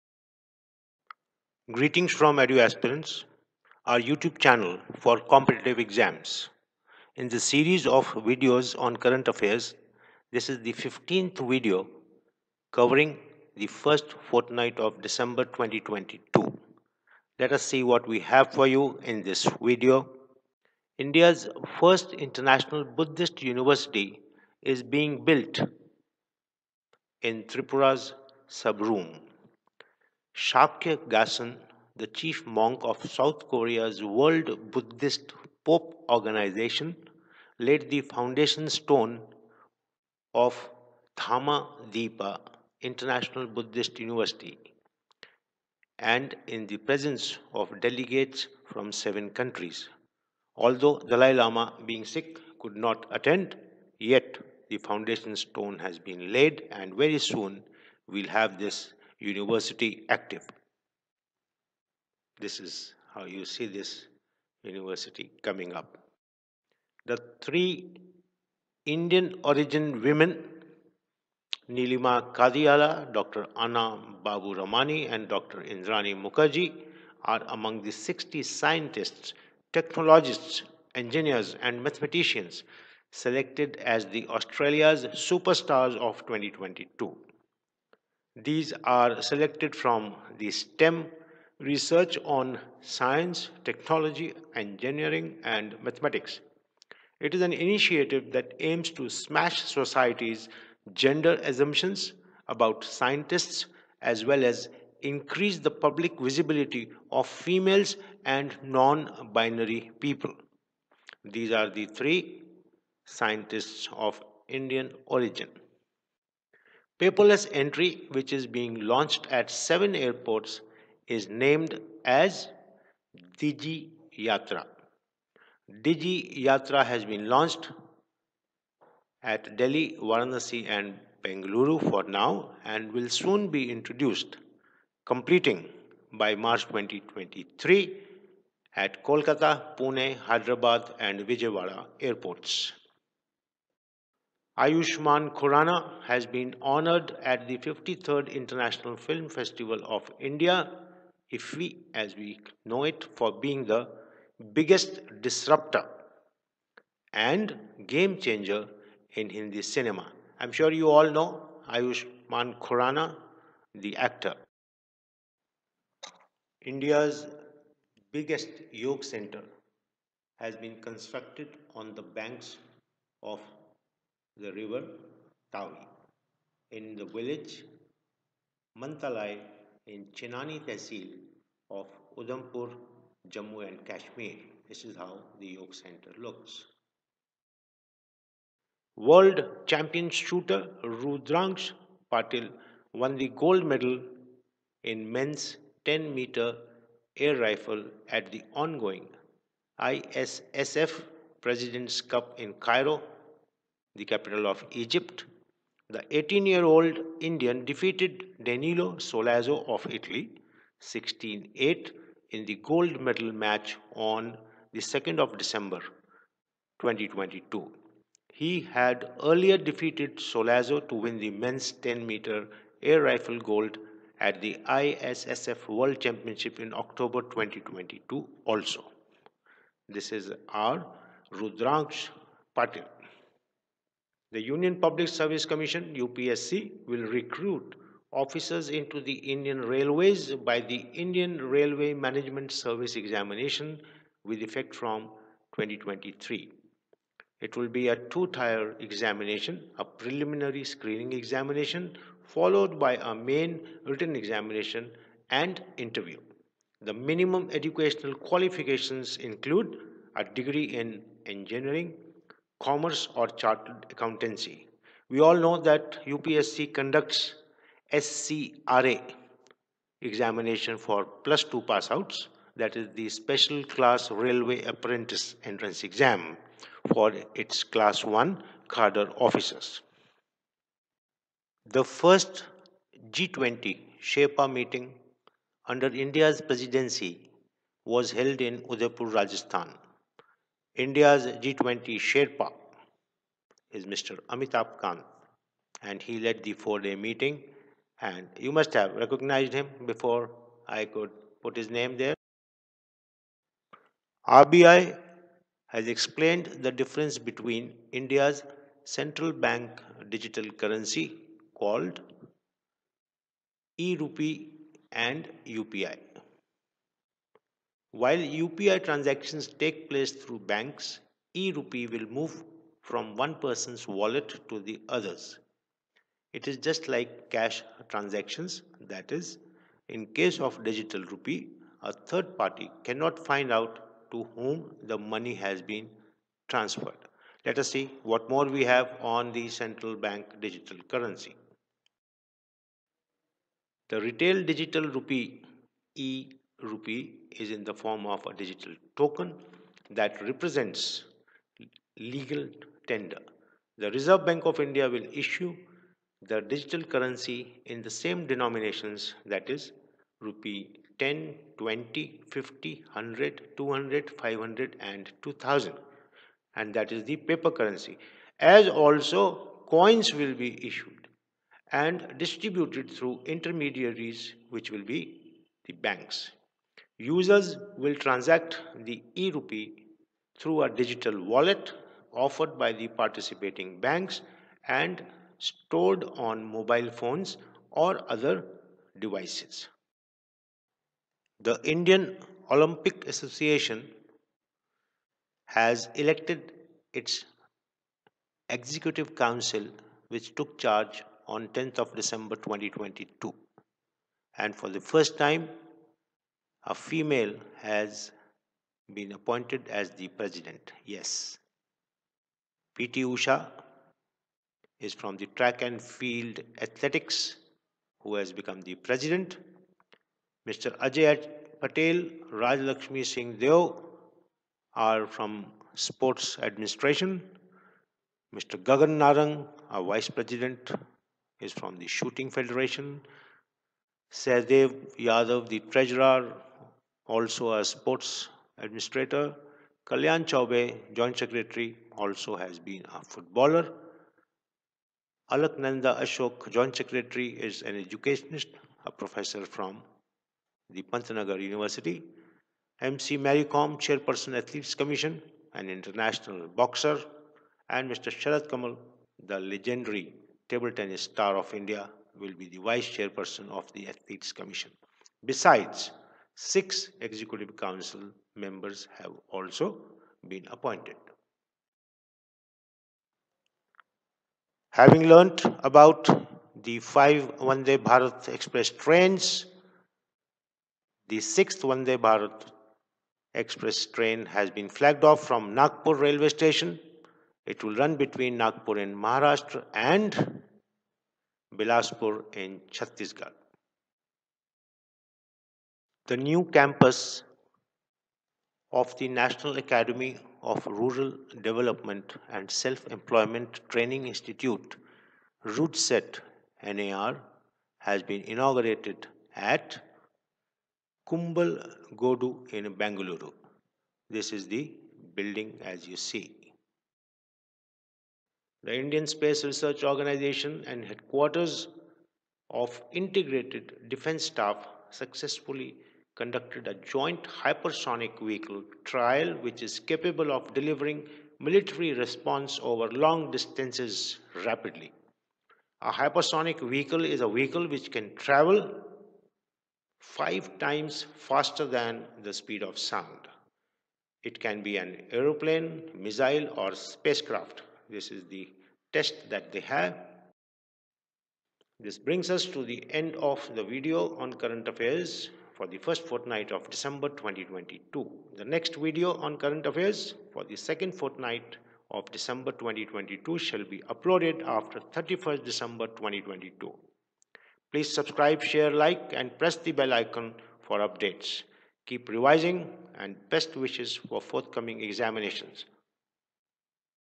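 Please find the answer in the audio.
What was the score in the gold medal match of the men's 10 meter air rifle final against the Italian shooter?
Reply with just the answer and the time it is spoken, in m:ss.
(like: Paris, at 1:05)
16-8, at 3:30.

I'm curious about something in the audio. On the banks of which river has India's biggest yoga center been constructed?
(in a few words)
Tawi.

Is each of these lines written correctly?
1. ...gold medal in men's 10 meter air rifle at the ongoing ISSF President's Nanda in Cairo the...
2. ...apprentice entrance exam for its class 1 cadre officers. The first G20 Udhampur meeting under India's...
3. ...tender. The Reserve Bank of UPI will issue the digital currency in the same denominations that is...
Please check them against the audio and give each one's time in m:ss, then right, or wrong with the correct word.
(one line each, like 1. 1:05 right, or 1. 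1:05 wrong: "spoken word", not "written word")
1. 3:13 wrong: "Cup", not "Nanda"
2. 4:34 wrong: "Sherpa", not "Udhampur"
3. 5:52 wrong: "India", not "UPI".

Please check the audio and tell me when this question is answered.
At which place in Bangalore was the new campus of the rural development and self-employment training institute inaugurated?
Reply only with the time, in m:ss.
8:31.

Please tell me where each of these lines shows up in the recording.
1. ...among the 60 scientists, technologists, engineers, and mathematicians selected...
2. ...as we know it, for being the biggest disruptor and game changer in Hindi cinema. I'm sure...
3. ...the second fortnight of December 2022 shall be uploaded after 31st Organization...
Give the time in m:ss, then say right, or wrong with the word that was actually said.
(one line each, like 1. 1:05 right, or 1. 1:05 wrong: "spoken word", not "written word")
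1. 1:17 right
2. 2:31 right
3. 9:20 wrong: "December", not "Organization".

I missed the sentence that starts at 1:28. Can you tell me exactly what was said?
These are selected from the STEM research on science, technology, engineering, and mathematics.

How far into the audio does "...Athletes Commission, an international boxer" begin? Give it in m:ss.
7:34.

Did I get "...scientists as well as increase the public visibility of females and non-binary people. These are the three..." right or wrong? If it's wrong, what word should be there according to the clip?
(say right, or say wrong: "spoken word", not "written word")
right.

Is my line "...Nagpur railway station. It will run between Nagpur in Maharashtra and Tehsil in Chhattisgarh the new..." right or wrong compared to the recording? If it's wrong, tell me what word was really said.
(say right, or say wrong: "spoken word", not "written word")
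wrong: "Bilaspur", not "Tehsil".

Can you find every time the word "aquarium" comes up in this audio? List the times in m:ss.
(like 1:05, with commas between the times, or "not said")
not said.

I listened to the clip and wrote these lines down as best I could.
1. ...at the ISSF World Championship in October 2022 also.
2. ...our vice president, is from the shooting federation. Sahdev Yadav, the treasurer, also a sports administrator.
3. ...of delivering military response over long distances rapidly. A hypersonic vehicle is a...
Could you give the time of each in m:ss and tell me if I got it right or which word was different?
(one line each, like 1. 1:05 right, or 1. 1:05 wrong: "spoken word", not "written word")
1. 3:44 right
2. 7:09 right
3. 8:50 right.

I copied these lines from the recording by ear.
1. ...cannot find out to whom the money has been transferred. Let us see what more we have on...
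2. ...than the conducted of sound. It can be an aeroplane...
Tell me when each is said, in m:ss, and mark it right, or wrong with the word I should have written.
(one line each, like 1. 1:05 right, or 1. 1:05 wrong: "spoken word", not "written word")
1. 5:32 right
2. 9:01 wrong: "speed", not "conducted".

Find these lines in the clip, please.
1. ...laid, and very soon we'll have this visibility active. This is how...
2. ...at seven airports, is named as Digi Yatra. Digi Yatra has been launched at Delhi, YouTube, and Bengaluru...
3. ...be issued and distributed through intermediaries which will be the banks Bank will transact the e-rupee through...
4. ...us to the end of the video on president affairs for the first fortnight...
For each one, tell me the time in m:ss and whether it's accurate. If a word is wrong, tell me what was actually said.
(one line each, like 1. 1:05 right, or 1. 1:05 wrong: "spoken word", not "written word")
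1. 0:56 wrong: "university", not "visibility"
2. 1:59 wrong: "Varanasi", not "YouTube"
3. 6:10 wrong: "Users", not "Bank"
4. 9:12 wrong: "current", not "president".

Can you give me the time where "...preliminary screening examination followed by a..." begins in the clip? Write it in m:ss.
4:09.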